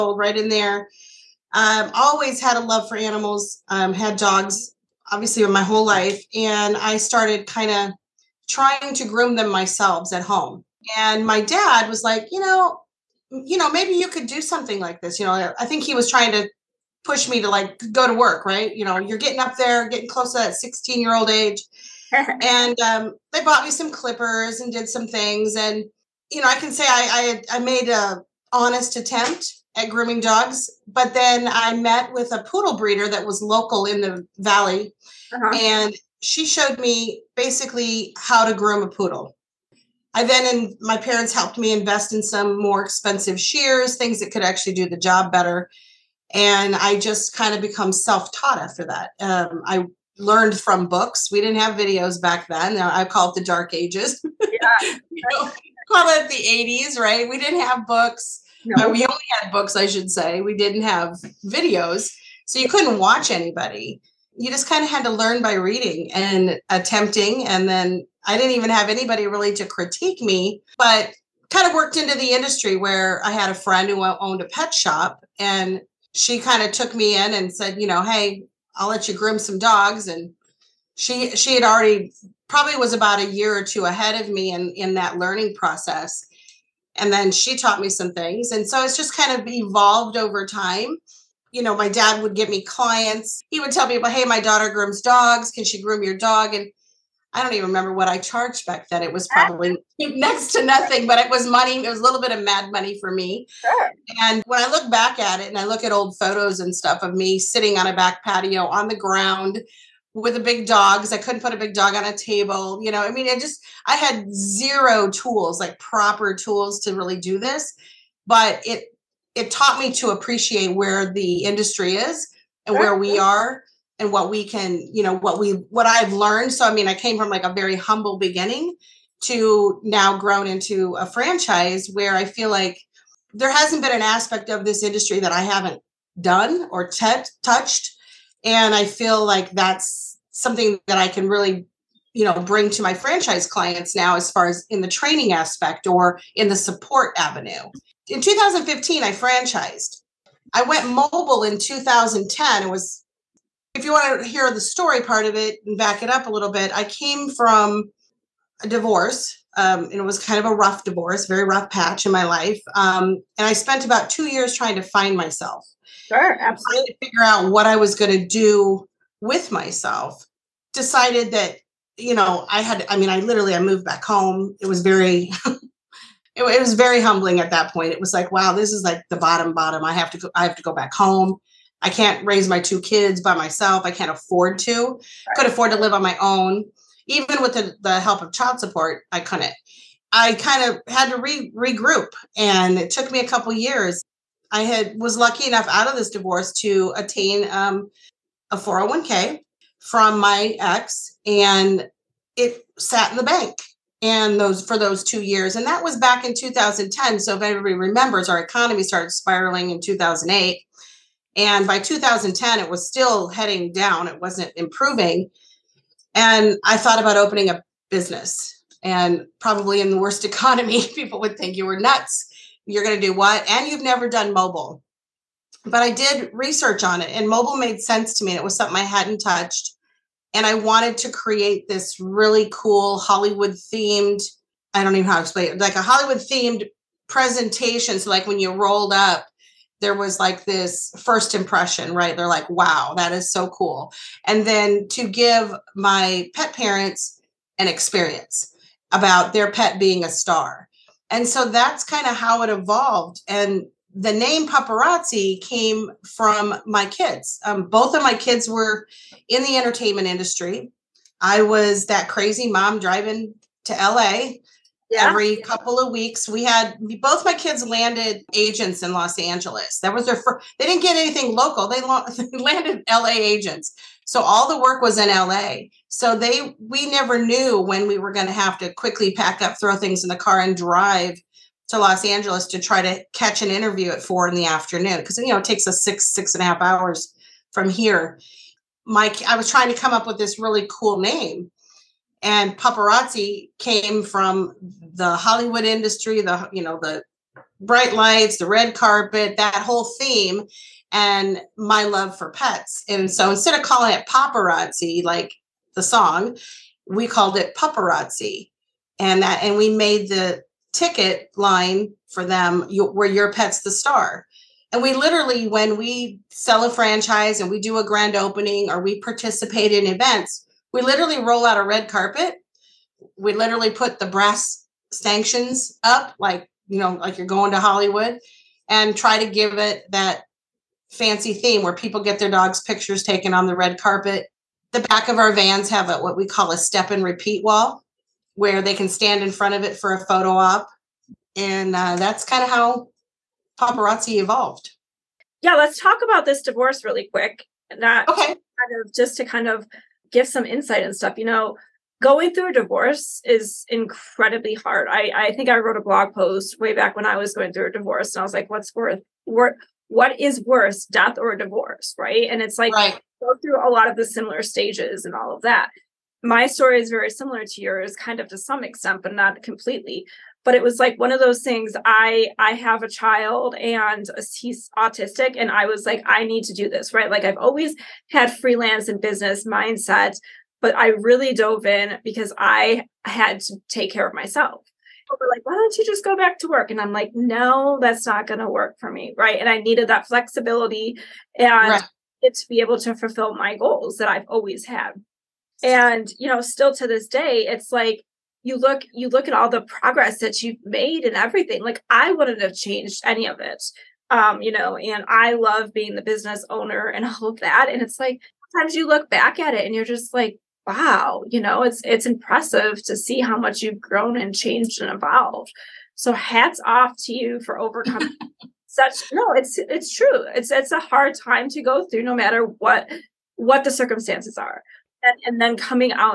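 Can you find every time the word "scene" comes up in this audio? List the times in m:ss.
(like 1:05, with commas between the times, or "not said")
not said.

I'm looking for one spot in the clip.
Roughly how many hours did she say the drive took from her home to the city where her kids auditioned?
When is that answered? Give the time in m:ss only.
4:45.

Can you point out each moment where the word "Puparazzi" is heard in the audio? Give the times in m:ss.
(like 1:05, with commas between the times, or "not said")
4:14, 5:07, 5:43.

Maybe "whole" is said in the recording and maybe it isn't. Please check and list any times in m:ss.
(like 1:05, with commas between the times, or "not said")
0:05, 4:59.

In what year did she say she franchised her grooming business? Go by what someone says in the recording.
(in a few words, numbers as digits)
2015.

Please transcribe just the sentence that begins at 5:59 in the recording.
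what is worse, death or a divorce, right?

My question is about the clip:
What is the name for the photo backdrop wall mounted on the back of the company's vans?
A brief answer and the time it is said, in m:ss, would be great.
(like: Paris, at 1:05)
Step and repeat wall, at 5:36.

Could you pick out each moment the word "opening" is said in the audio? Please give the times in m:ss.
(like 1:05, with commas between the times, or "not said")
3:37, 5:18.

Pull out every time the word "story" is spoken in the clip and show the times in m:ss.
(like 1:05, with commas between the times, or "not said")
2:34, 6:06.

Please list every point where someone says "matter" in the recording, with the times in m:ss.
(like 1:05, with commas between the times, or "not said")
7:02.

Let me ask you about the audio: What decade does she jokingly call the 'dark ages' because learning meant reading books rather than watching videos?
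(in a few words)
The 80s.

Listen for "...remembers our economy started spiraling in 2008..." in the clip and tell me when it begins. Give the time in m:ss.
3:27.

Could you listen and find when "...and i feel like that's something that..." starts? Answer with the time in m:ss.
2:18.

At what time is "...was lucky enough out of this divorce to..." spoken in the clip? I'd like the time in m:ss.
3:14.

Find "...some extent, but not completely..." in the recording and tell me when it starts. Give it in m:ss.
6:08.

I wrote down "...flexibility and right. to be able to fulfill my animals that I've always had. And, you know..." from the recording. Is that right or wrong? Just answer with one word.
wrong.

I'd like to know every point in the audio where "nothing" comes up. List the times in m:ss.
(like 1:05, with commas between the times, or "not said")
1:40.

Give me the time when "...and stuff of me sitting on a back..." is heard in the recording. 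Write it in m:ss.
1:46.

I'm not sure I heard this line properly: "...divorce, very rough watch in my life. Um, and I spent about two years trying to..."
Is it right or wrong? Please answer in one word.
wrong.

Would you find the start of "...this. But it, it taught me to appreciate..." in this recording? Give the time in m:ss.
1:57.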